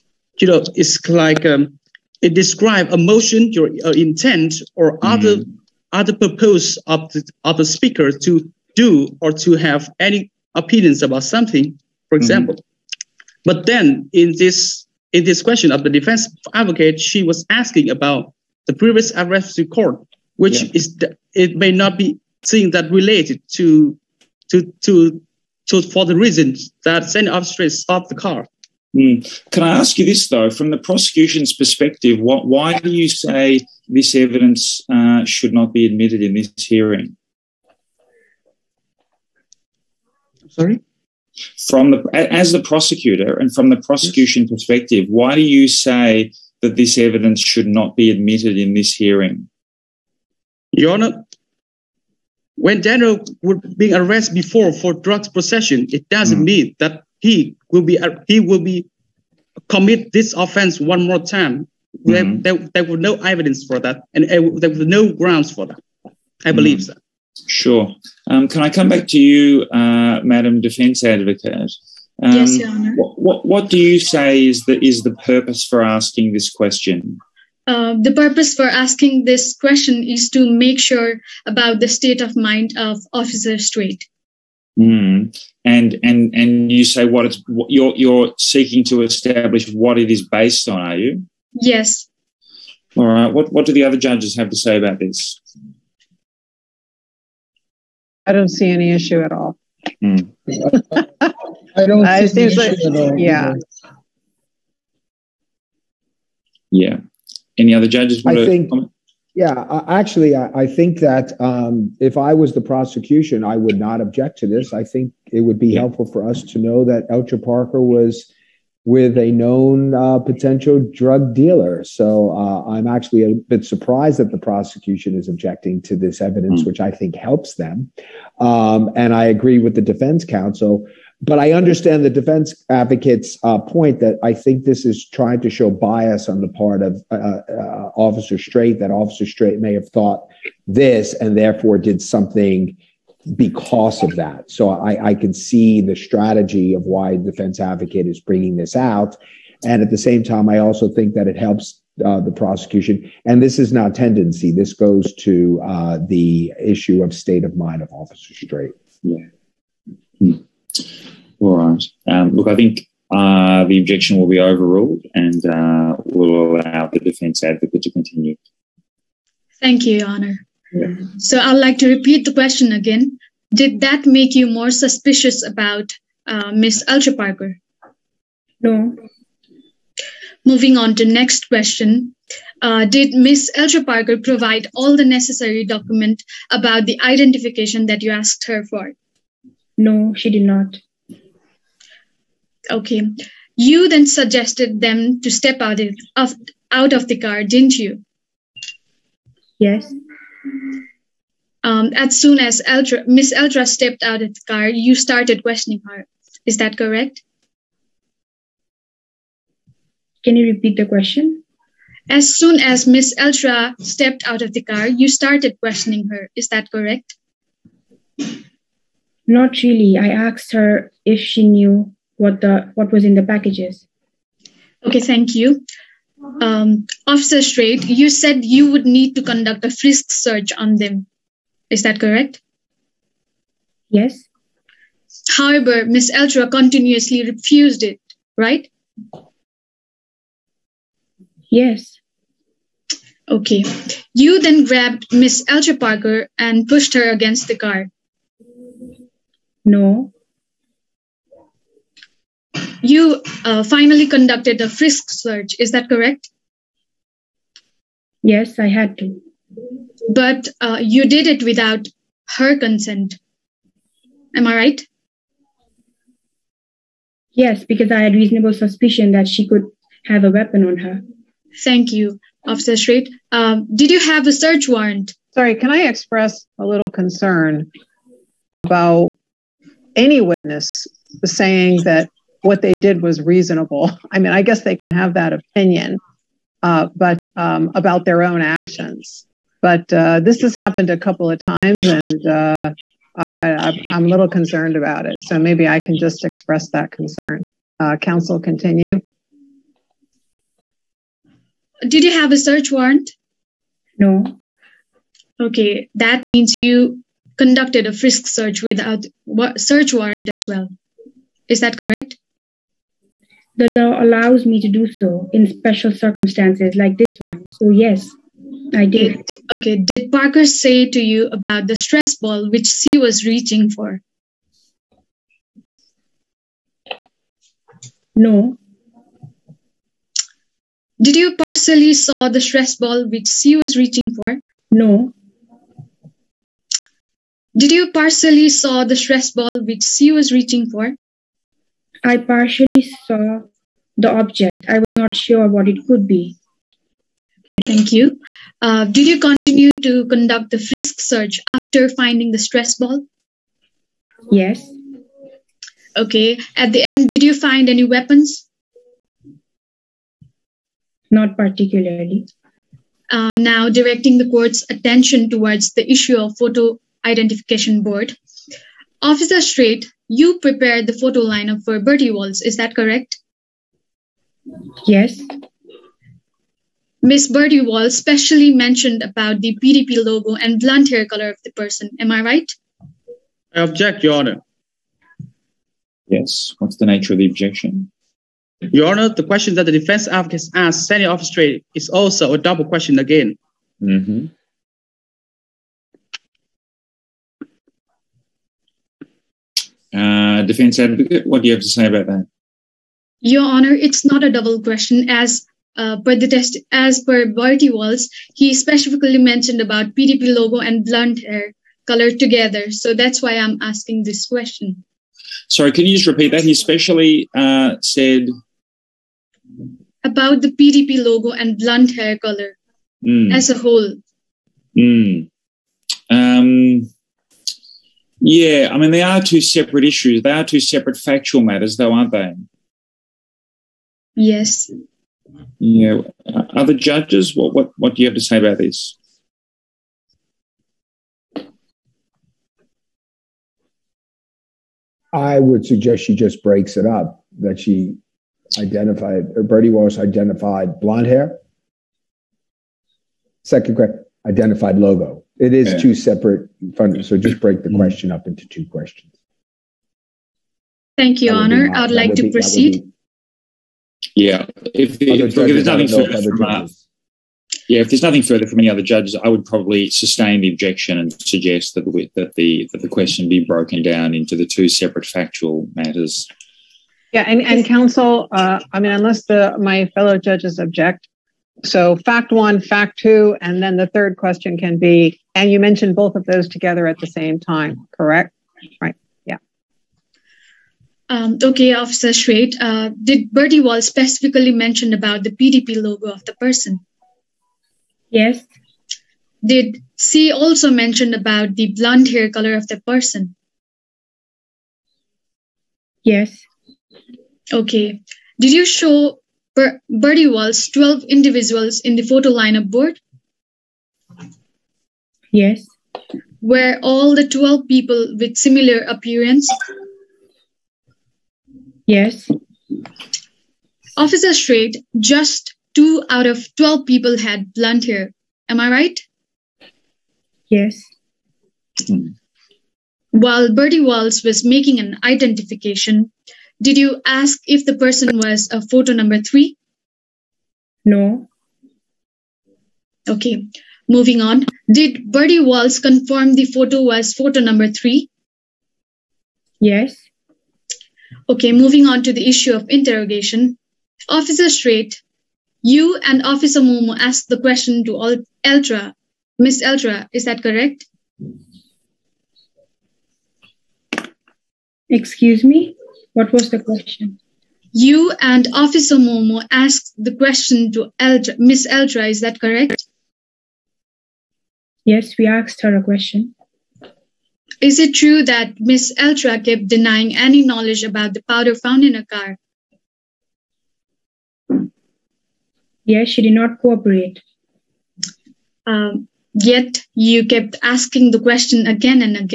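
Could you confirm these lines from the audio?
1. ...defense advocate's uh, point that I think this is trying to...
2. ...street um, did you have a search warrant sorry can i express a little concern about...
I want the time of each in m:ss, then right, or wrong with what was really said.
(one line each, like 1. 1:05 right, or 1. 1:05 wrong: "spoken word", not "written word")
1. 2:12 right
2. 4:32 right.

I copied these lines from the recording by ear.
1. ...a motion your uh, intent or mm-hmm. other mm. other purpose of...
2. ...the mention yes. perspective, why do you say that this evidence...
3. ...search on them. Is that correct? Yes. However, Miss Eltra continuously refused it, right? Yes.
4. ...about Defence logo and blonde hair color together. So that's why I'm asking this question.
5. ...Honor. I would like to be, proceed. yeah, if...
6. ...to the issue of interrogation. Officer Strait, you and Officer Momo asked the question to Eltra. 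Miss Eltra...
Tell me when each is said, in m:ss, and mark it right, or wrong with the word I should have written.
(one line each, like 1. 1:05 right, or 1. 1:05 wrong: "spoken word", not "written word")
1. 0:02 right
2. 0:43 wrong: "prosecution", not "mention"
3. 3:50 right
4. 6:49 wrong: "PDP", not "Defence"
5. 7:41 right
6. 9:12 right.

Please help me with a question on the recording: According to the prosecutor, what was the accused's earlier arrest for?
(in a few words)
Drugs possession.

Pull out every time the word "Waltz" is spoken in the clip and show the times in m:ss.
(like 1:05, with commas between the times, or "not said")
6:12, 6:17.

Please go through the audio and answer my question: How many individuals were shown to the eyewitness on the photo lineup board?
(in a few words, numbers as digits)
12.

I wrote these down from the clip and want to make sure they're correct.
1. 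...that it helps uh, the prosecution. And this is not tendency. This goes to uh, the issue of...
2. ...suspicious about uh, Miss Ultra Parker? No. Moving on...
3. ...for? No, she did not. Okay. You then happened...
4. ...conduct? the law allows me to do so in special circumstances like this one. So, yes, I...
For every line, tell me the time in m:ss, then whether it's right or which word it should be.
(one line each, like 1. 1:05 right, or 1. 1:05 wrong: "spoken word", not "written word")
1. 2:31 right
2. 2:54 right
3. 3:08 wrong: "suggested", not "happened"
4. 5:11 wrong: "correct", not "conduct".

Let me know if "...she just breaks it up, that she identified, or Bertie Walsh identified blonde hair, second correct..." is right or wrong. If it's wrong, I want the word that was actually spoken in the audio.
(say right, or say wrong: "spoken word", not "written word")
right.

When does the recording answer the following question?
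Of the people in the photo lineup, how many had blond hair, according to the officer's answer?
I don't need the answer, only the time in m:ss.
8:45.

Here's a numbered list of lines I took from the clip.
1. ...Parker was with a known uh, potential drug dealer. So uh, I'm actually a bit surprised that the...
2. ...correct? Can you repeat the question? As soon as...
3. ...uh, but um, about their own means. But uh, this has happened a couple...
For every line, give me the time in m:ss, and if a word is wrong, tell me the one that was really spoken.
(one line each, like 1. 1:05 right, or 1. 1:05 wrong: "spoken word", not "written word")
1. 1:57 right
2. 3:26 right
3. 4:46 wrong: "actions", not "means".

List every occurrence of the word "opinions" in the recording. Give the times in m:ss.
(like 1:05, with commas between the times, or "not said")
0:10, 4:45.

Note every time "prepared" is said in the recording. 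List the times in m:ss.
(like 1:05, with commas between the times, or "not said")
6:10.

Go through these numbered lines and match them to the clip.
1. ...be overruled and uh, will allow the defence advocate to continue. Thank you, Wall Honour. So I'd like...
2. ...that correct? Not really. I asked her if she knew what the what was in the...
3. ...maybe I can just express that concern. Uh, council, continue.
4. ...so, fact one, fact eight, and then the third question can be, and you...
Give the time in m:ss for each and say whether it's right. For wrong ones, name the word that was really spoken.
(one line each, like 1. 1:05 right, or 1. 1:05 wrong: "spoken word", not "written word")
1. 2:44 wrong: "Your", not "Wall"
2. 3:36 right
3. 4:55 right
4. 8:01 wrong: "two", not "eight".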